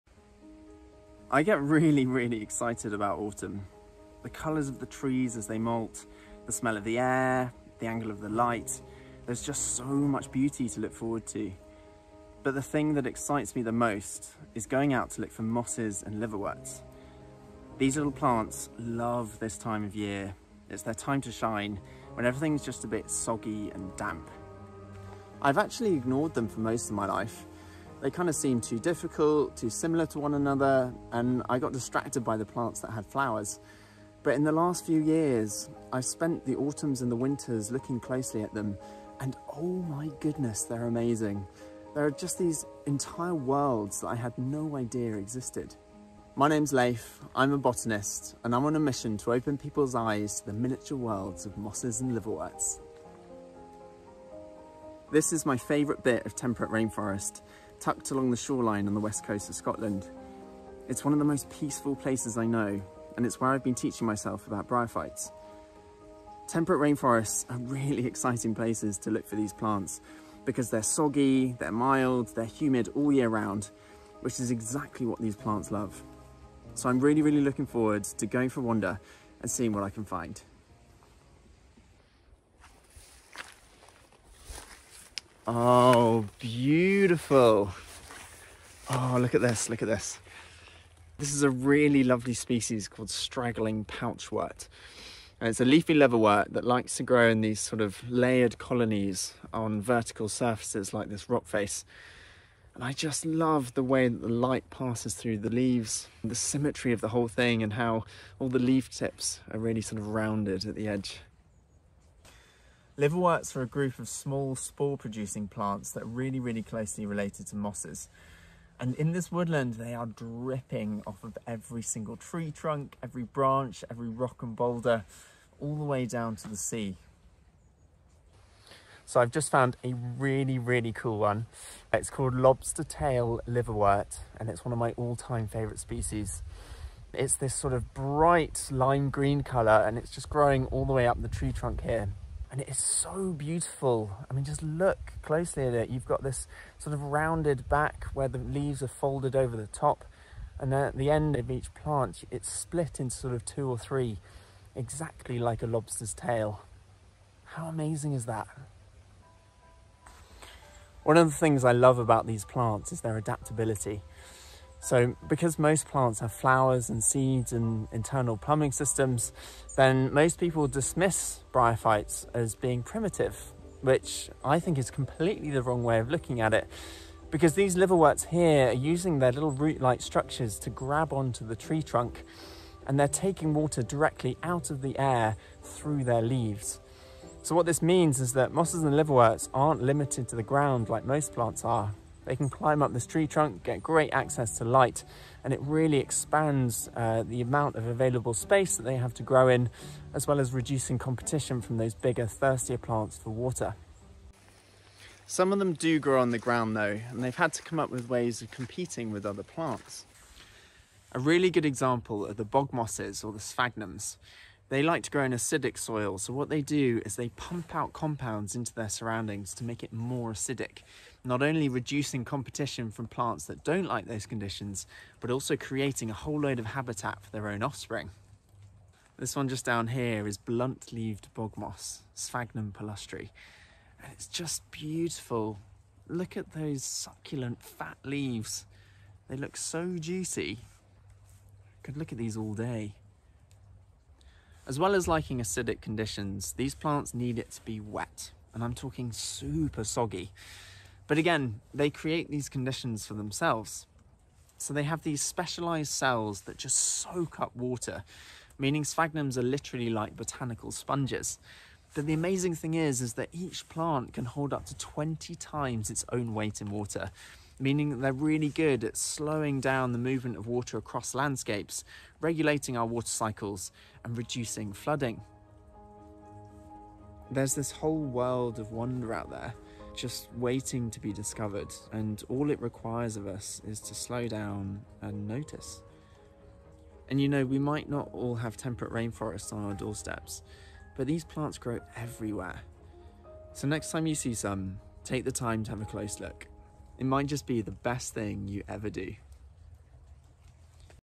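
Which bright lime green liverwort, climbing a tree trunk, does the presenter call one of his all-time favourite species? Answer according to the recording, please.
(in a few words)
Lobster tail liverwort.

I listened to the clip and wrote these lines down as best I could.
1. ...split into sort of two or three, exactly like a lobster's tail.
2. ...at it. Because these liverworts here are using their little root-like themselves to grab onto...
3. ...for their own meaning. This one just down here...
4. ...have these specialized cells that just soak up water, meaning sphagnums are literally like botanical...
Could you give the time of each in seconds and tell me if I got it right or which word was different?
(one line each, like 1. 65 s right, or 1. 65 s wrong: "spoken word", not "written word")
1. 152 s right
2. 176 s wrong: "structures", not "themselves"
3. 227 s wrong: "offspring", not "meaning"
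4. 254 s right.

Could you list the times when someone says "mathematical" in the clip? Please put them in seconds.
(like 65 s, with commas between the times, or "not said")
not said.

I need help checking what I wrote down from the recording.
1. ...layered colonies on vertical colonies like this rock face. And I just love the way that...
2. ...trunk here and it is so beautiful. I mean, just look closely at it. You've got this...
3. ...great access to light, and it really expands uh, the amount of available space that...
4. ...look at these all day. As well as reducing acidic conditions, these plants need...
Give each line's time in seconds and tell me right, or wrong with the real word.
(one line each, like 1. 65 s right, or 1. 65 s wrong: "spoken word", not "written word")
1. 98 s wrong: "surfaces", not "colonies"
2. 141 s right
3. 193 s right
4. 241 s wrong: "liking", not "reducing".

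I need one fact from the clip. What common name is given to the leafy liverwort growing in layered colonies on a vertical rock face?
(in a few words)
Straggling pouchwort.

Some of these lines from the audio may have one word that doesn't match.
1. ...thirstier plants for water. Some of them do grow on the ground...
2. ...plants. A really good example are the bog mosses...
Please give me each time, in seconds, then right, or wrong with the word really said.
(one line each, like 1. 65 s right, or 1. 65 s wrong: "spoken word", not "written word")
1. 202 s right
2. 209 s right.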